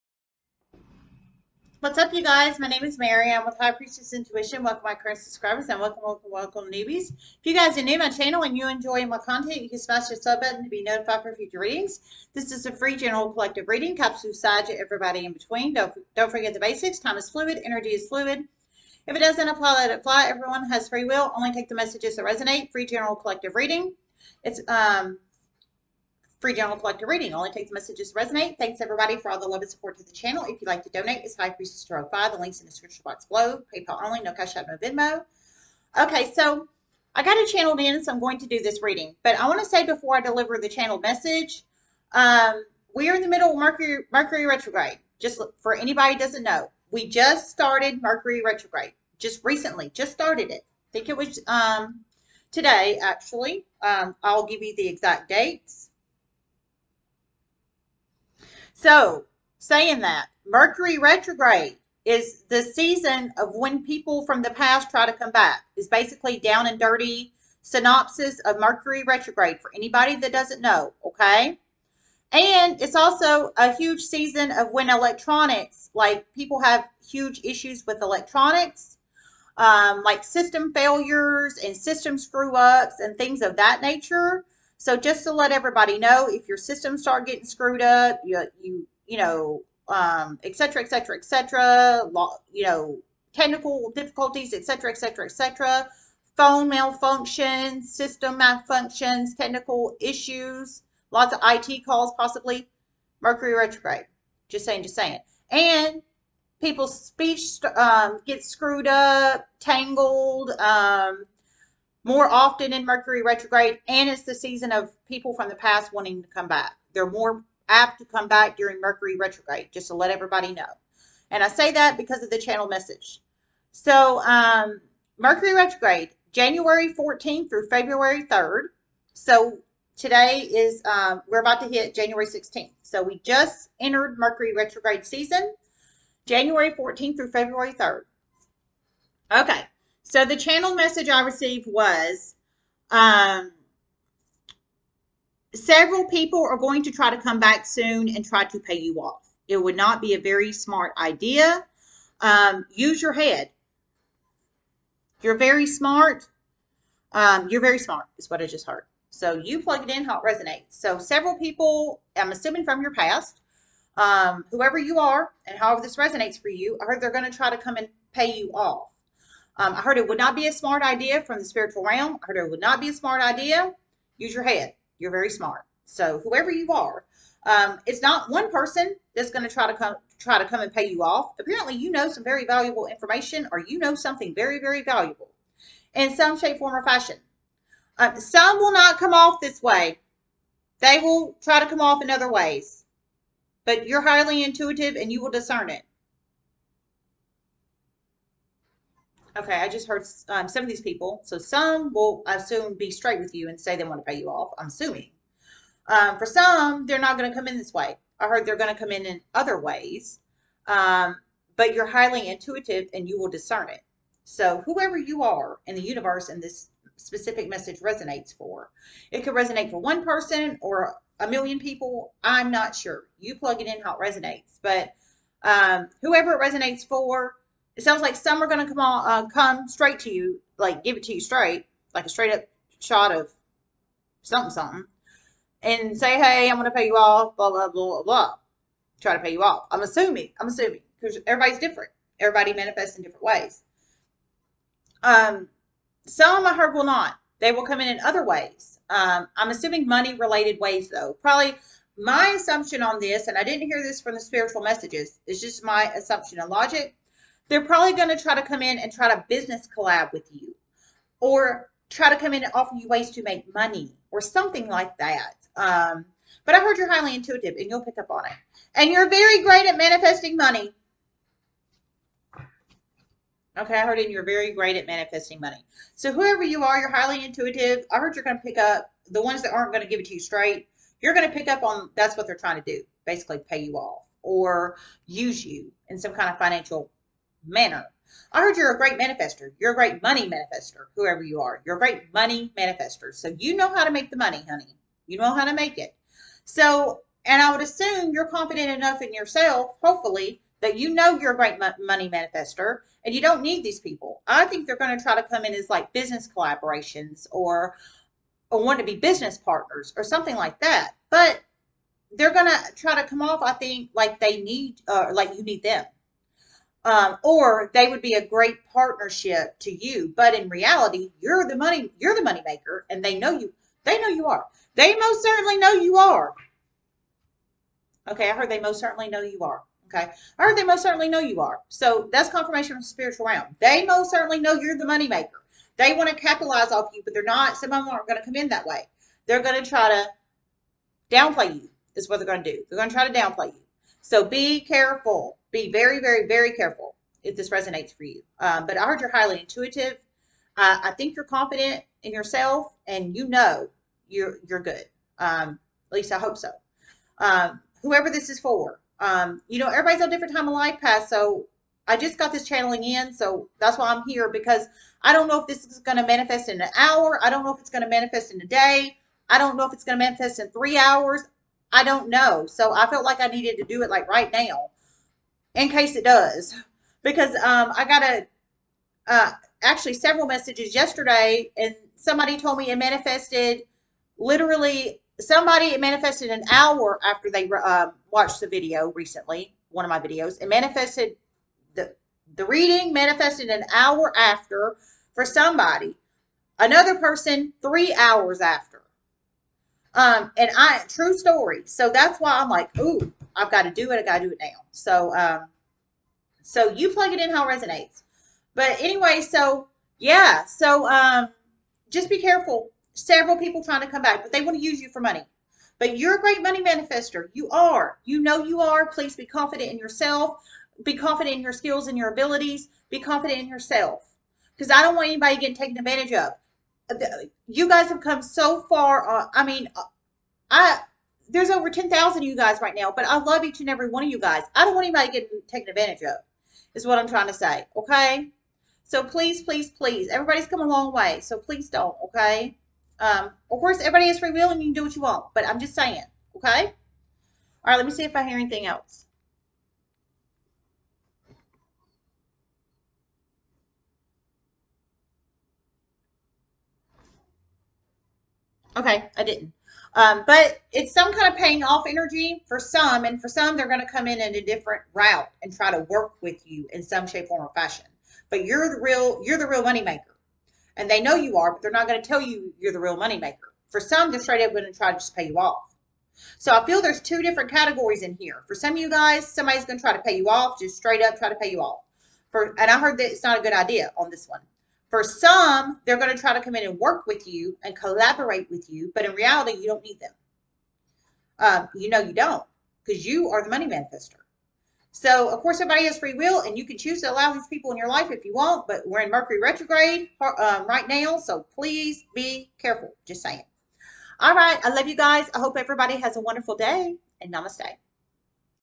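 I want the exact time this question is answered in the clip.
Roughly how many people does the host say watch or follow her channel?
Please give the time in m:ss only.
7:11.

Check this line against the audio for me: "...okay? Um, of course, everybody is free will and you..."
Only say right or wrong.
right.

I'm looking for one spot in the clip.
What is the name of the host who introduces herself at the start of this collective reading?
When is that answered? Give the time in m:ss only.
0:02.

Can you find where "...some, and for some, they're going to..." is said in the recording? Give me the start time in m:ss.
7:42.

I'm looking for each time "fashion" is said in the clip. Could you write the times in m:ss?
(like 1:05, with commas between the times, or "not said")
3:06, 7:47.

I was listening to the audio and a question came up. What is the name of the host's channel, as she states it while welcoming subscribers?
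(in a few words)
High Priestess Intuition.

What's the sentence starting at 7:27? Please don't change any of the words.
All right, let me see if I hear anything else.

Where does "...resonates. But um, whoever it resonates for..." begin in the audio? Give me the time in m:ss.
3:43.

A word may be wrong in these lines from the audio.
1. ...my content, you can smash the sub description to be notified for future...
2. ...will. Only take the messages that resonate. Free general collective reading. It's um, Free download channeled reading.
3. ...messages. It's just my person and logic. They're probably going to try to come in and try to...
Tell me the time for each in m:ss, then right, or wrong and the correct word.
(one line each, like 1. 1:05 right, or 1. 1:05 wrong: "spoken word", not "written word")
1. 0:09 wrong: "button", not "description"
2. 0:21 wrong: "collected", not "channeled"
3. 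4:14 wrong: "assumption", not "person".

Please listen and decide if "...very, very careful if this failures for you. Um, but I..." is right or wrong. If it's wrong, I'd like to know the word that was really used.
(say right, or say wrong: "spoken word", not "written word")
wrong: "resonates", not "failures".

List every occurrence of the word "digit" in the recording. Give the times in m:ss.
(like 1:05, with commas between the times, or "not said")
not said.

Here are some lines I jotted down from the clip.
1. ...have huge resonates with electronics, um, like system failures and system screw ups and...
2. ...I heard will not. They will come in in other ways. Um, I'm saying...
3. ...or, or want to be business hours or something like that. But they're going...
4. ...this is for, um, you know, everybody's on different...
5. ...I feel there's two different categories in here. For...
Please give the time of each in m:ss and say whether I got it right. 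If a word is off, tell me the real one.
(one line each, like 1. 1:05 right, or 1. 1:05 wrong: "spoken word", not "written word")
1. 1:16 wrong: "issues", not "resonates"
2. 4:06 wrong: "assuming", not "saying"
3. 5:07 wrong: "partners", not "hours"
4. 5:58 right
5. 7:56 right.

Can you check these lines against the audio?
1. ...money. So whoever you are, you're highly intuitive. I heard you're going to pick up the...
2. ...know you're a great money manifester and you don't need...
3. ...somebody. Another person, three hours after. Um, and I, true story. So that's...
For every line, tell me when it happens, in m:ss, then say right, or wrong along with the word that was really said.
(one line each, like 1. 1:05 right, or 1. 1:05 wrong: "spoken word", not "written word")
1. 4:35 right
2. 5:00 right
3. 6:35 right.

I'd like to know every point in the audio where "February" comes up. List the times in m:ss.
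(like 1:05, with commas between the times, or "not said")
2:07, 2:17.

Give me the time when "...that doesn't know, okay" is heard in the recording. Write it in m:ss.
1:10.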